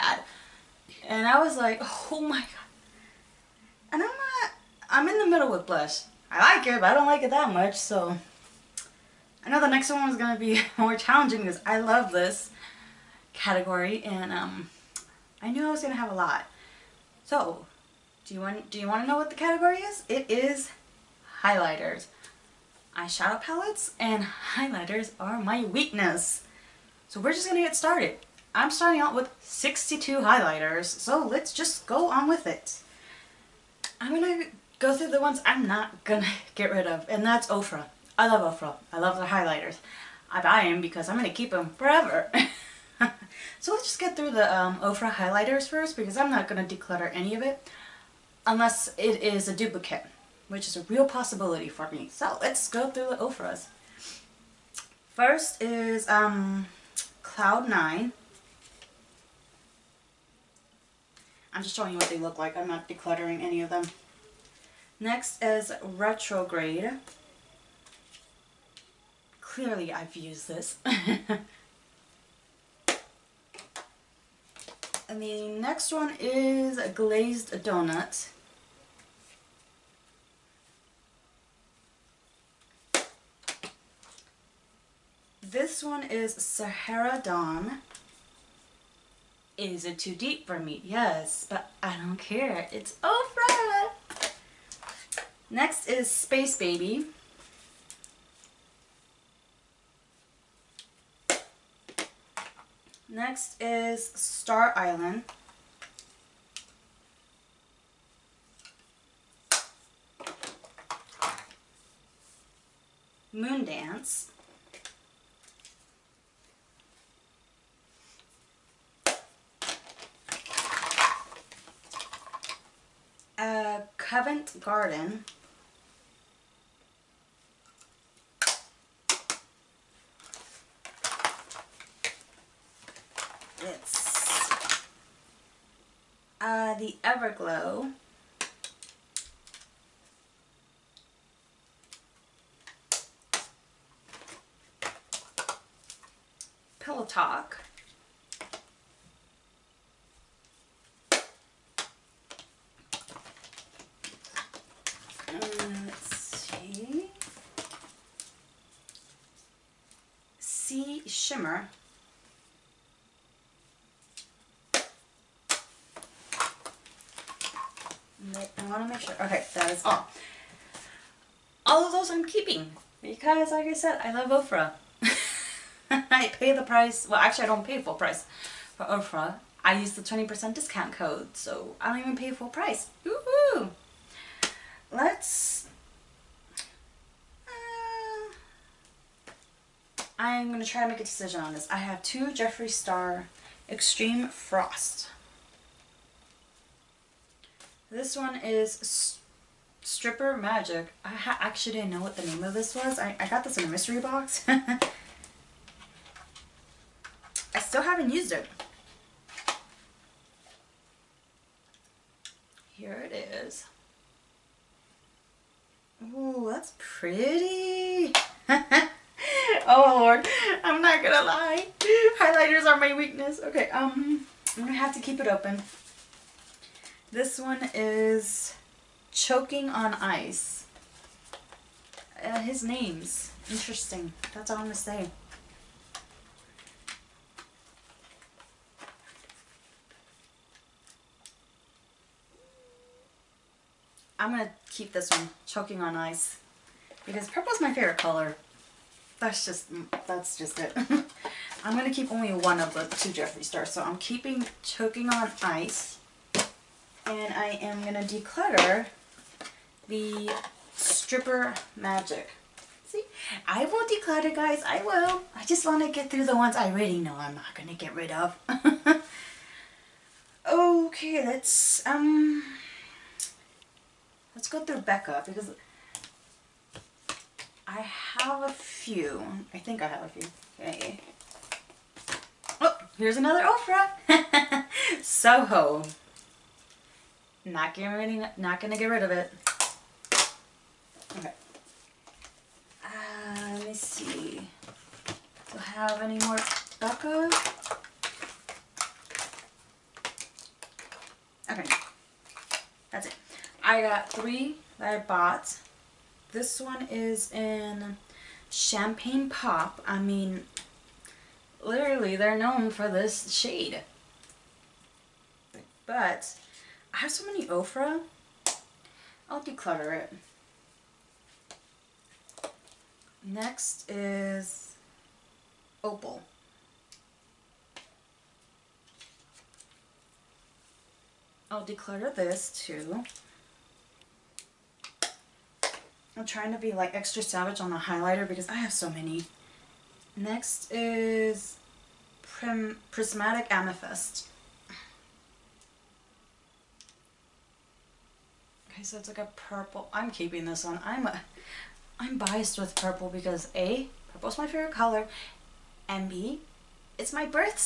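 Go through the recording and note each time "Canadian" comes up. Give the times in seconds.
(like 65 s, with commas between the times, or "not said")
not said.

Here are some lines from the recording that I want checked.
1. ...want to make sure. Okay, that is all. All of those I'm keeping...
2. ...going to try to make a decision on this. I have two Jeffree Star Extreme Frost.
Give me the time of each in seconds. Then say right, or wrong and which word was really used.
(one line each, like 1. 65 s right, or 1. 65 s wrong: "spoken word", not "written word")
1. 168 s right
2. 190 s right.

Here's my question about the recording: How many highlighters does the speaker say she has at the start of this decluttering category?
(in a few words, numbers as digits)
62.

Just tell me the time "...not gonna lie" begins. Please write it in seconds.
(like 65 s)
220 s.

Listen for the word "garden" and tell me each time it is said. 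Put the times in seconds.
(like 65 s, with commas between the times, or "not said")
124 s.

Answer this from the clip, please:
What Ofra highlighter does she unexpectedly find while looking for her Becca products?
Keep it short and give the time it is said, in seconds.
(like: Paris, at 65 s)
Soho, at 285 s.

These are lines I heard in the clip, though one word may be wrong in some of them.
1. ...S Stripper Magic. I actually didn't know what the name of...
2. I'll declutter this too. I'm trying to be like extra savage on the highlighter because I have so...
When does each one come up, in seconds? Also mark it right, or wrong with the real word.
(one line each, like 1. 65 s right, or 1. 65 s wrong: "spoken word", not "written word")
1. 198 s right
2. 331 s right.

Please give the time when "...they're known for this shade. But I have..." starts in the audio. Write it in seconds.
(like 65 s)
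312 s.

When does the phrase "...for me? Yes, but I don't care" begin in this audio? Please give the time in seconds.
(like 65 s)
90 s.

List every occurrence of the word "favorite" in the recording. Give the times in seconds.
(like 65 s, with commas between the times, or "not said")
247 s, 354 s.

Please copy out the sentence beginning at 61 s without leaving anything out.
I'm just showing you what they look like.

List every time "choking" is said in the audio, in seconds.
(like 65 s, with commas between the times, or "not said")
229 s, 245 s, 254 s.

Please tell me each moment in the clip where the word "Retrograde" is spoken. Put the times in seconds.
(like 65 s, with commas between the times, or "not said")
65 s.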